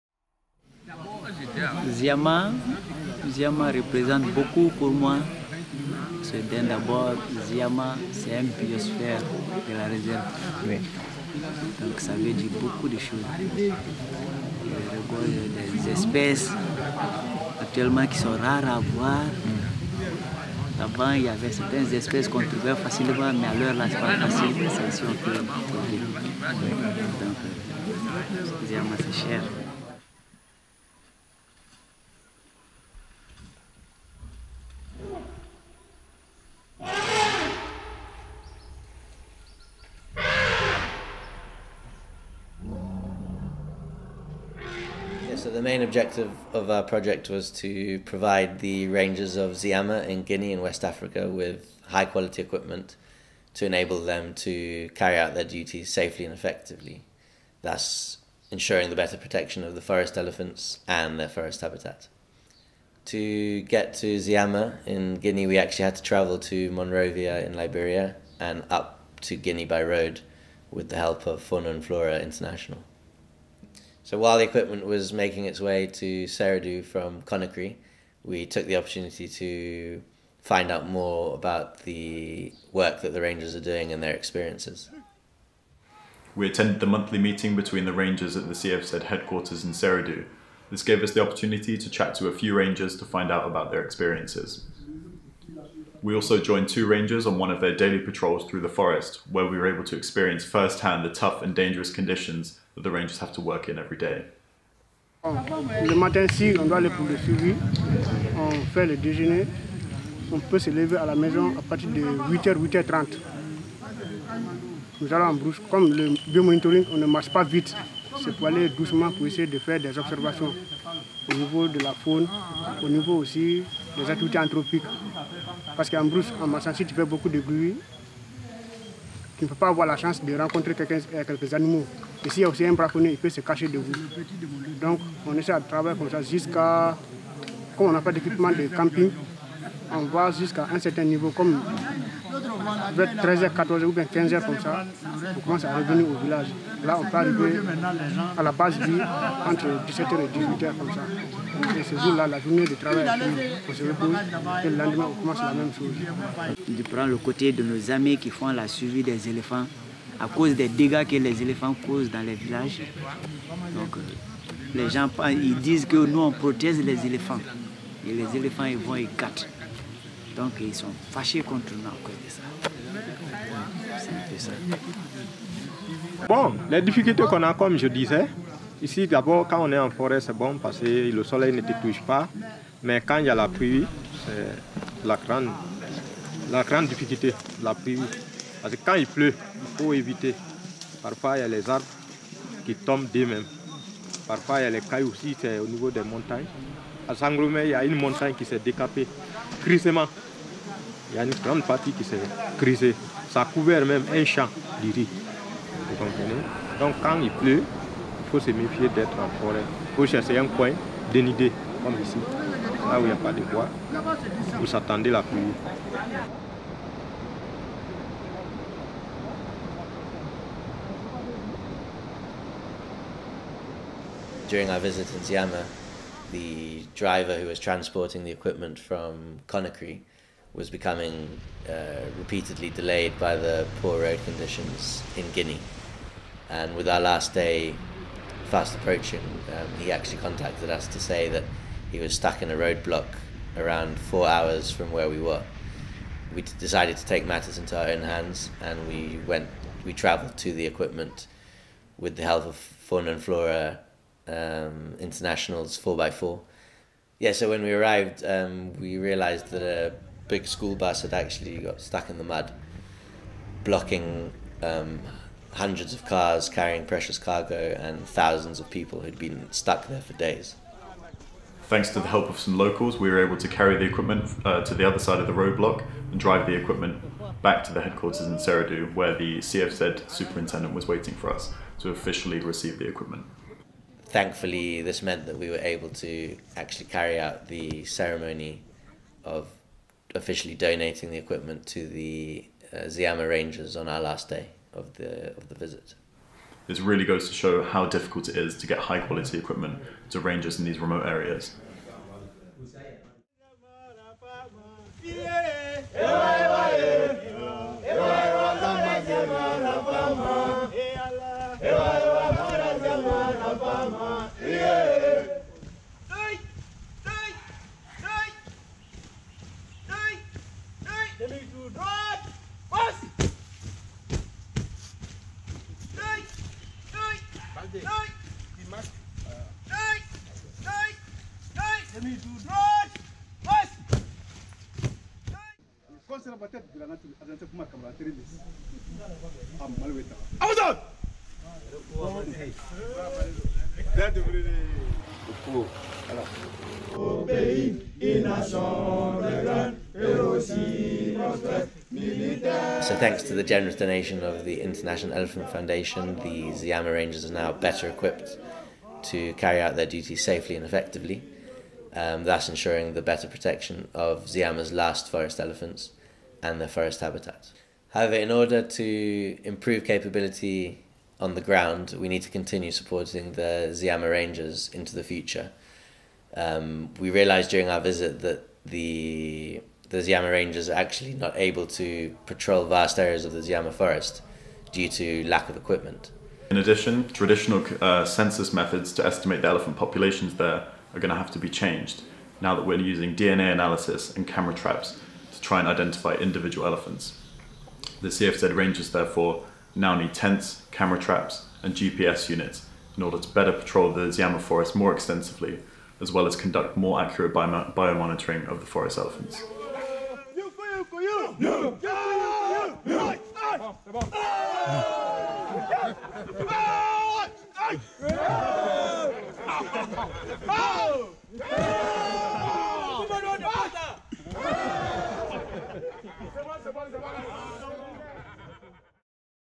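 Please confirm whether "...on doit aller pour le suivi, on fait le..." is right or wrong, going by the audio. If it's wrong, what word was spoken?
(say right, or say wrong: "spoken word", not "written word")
right.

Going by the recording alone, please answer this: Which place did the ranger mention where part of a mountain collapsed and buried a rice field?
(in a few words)
Sangromé.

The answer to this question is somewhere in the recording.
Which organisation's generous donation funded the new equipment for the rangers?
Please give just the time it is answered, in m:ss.
5:54.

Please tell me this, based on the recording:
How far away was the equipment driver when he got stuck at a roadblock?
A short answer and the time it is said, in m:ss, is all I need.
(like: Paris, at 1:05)
four hours, at 4:03.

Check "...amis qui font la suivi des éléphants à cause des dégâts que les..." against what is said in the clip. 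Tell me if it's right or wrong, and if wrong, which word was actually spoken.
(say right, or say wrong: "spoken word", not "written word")
right.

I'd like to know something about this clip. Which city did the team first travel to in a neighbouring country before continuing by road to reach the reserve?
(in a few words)
Monrovia.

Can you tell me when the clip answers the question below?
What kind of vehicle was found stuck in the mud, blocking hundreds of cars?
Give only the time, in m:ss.
4:20.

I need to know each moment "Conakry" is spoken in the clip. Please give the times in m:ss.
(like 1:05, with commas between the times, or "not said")
1:17, 3:49.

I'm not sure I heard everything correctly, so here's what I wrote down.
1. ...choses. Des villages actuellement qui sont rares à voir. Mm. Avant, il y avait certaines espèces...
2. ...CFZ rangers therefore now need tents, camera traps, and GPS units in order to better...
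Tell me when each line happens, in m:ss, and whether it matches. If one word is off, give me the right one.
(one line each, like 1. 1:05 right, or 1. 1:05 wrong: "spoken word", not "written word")
1. 0:12 wrong: "espèces", not "villages"
2. 6:38 right.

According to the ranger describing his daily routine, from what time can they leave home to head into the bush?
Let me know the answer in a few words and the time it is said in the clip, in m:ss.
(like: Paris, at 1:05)
8h, at 1:52.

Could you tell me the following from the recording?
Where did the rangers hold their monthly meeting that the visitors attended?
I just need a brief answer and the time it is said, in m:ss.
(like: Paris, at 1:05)
CFZ headquarters in Seredou, at 1:28.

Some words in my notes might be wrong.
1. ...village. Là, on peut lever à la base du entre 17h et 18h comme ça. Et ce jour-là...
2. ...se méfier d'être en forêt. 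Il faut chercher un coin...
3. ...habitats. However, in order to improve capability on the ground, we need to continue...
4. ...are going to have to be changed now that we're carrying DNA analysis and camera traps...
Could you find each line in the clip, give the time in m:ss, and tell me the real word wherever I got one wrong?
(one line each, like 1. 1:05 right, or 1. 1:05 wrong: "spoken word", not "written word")
1. 2:26 wrong: "arriver", not "lever"
2. 3:28 right
3. 6:07 right
4. 6:30 wrong: "using", not "carrying".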